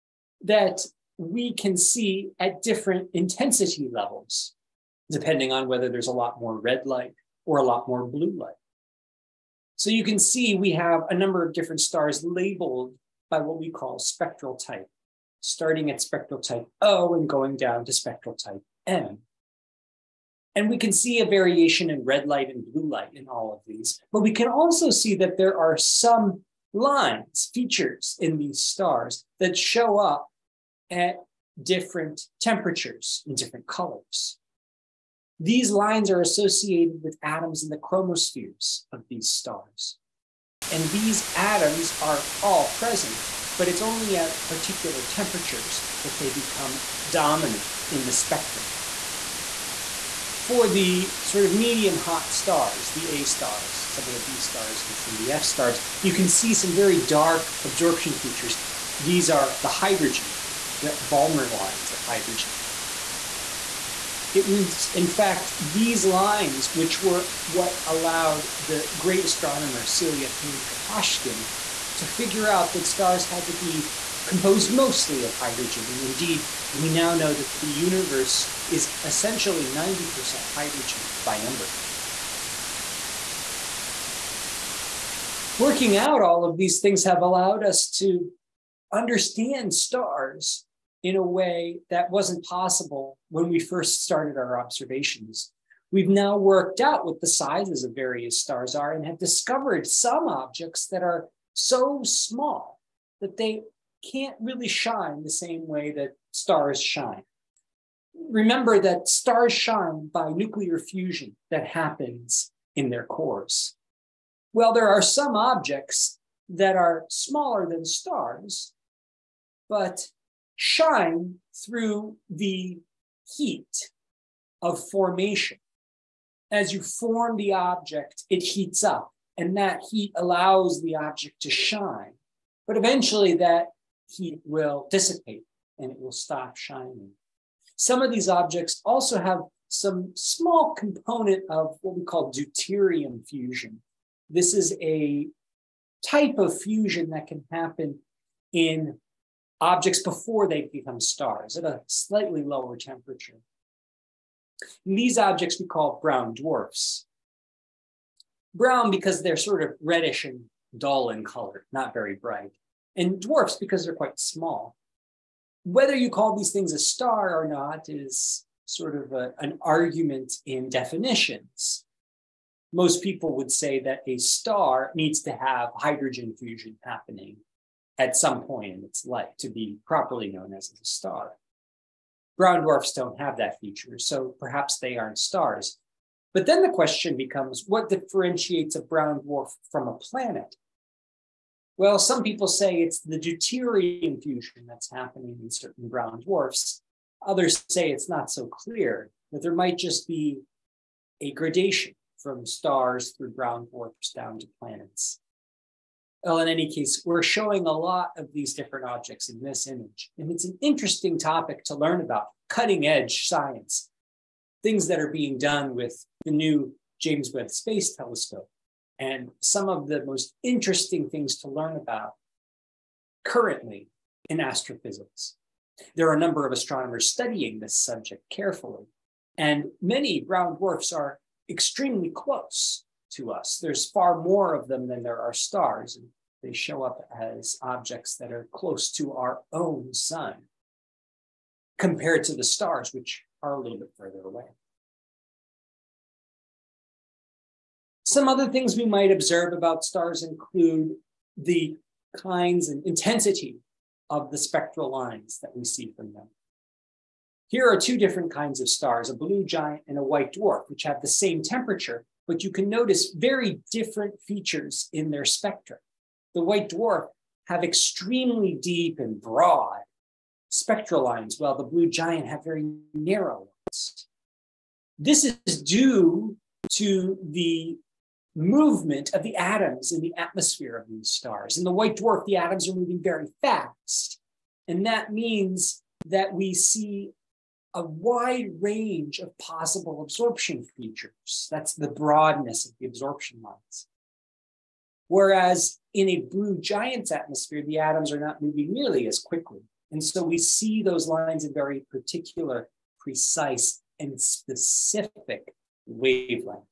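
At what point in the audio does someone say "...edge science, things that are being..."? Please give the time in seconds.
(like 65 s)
212 s.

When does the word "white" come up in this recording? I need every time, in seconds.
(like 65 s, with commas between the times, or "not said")
260 s, 266 s, 281 s.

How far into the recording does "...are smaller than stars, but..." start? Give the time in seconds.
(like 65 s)
116 s.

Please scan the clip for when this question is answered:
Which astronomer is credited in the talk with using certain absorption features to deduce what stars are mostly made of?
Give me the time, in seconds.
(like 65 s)
69 s.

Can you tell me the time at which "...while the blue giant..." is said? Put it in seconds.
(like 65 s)
271 s.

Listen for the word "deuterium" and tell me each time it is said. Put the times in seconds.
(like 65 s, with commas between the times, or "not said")
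142 s, 193 s.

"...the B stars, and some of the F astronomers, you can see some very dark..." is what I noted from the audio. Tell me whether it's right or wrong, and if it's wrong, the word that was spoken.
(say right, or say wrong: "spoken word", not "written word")
wrong: "stars", not "astronomers".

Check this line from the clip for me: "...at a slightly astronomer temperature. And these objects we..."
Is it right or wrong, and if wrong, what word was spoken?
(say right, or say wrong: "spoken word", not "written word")
wrong: "lower", not "astronomer".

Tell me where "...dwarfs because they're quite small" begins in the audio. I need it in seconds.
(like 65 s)
163 s.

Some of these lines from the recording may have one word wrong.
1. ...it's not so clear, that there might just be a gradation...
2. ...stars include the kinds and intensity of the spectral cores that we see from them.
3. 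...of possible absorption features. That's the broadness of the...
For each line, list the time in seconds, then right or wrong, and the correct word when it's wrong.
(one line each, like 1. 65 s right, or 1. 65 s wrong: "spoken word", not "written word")
1. 197 s right
2. 249 s wrong: "lines", not "cores"
3. 289 s right.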